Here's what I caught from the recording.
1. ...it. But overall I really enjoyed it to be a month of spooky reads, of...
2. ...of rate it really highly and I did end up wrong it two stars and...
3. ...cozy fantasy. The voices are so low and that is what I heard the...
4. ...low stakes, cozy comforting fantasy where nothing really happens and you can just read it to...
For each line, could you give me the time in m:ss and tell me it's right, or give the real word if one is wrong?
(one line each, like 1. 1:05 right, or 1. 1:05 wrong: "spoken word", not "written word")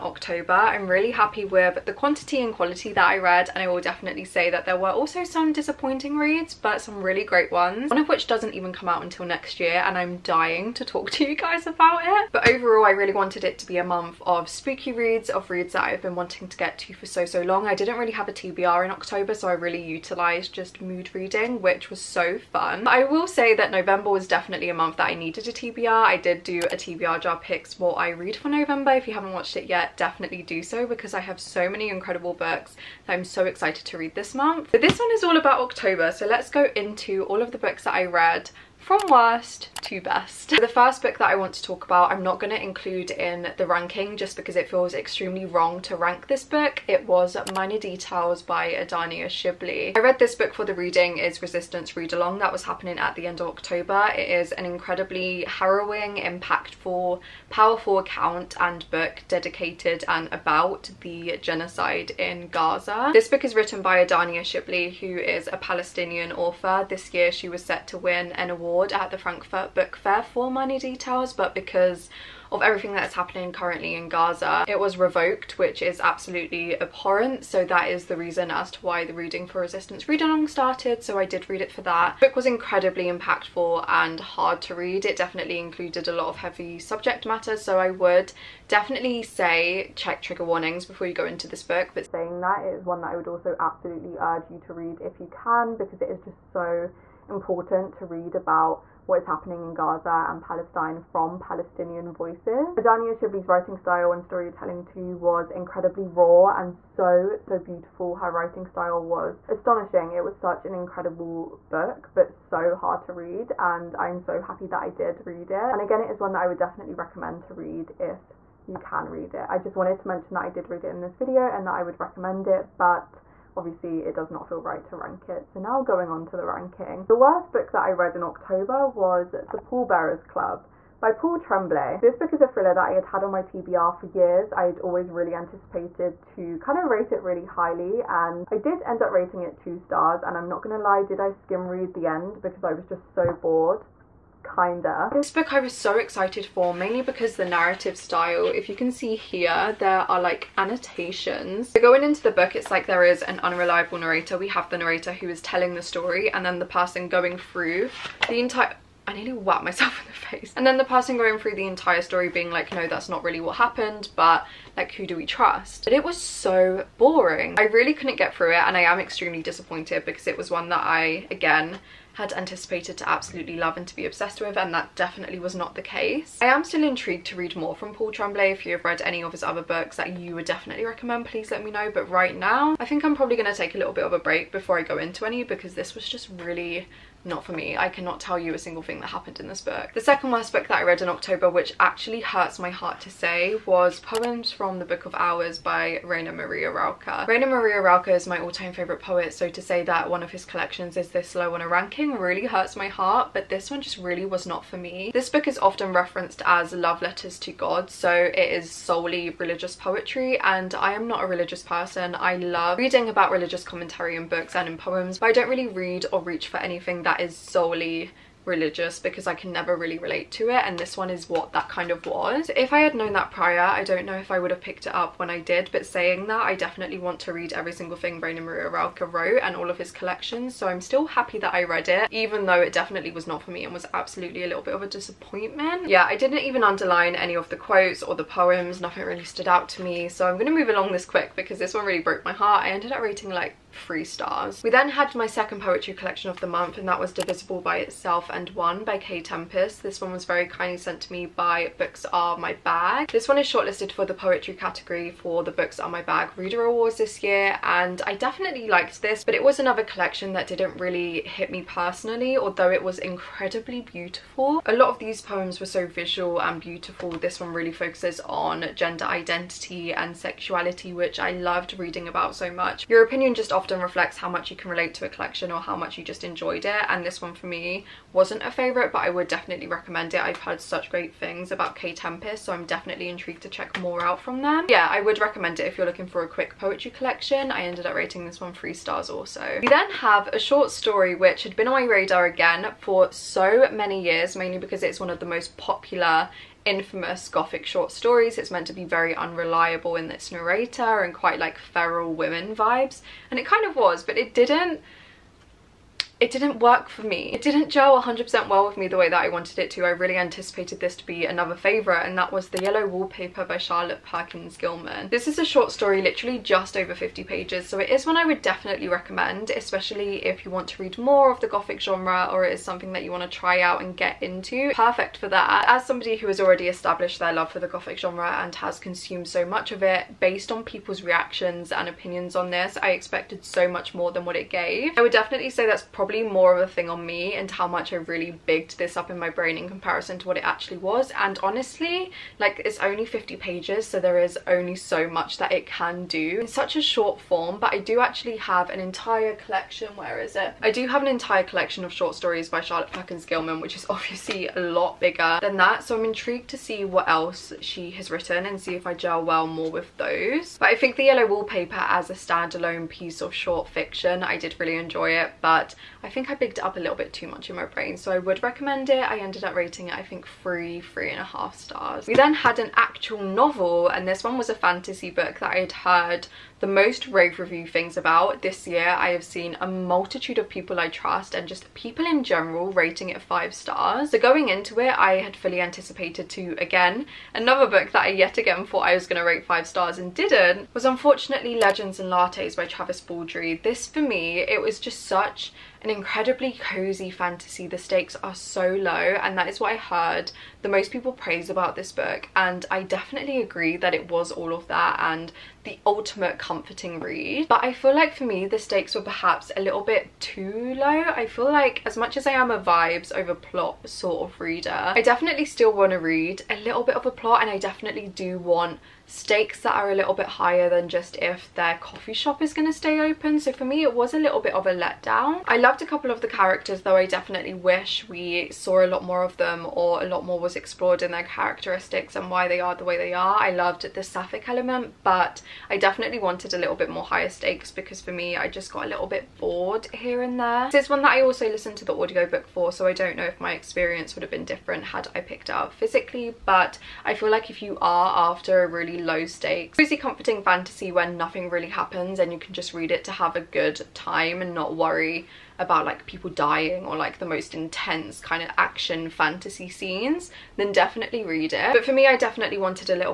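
1. 0:12 wrong: "wanted", not "enjoyed"
2. 2:16 wrong: "rating", not "wrong"
3. 6:36 wrong: "stakes", not "voices"
4. 7:29 right.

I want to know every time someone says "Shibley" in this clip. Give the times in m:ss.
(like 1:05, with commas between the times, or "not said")
0:49, 1:04, 1:43.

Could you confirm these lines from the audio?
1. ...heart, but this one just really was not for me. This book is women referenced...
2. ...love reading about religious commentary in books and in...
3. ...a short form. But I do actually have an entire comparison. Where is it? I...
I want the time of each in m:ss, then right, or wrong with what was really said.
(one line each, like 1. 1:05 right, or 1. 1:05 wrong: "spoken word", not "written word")
1. 3:22 wrong: "often", not "women"
2. 3:32 right
3. 5:46 wrong: "collection", not "comparison".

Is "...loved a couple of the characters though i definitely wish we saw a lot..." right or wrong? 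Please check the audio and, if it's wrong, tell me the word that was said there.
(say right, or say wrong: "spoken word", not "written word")
right.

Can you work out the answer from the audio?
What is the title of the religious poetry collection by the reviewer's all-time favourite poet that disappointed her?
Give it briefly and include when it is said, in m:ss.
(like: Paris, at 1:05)
Poems from the Book of Hours, at 3:13.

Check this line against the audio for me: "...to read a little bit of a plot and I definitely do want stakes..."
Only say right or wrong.
right.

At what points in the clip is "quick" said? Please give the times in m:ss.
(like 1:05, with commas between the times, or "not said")
4:01, 4:46.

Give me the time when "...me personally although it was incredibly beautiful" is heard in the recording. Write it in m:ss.
4:21.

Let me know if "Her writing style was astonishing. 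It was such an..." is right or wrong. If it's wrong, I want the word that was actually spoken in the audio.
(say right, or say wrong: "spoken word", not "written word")
right.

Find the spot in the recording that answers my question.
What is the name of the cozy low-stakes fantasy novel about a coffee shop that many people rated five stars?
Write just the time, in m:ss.
6:31.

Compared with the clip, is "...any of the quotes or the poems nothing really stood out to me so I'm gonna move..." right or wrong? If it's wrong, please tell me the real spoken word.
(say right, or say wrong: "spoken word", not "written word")
right.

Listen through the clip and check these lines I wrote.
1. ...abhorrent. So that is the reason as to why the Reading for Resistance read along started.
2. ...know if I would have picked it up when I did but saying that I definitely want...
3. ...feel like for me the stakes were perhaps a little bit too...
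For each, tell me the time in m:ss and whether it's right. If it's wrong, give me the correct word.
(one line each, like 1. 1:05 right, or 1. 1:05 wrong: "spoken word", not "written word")
1. 1:16 right
2. 3:44 right
3. 6:47 right.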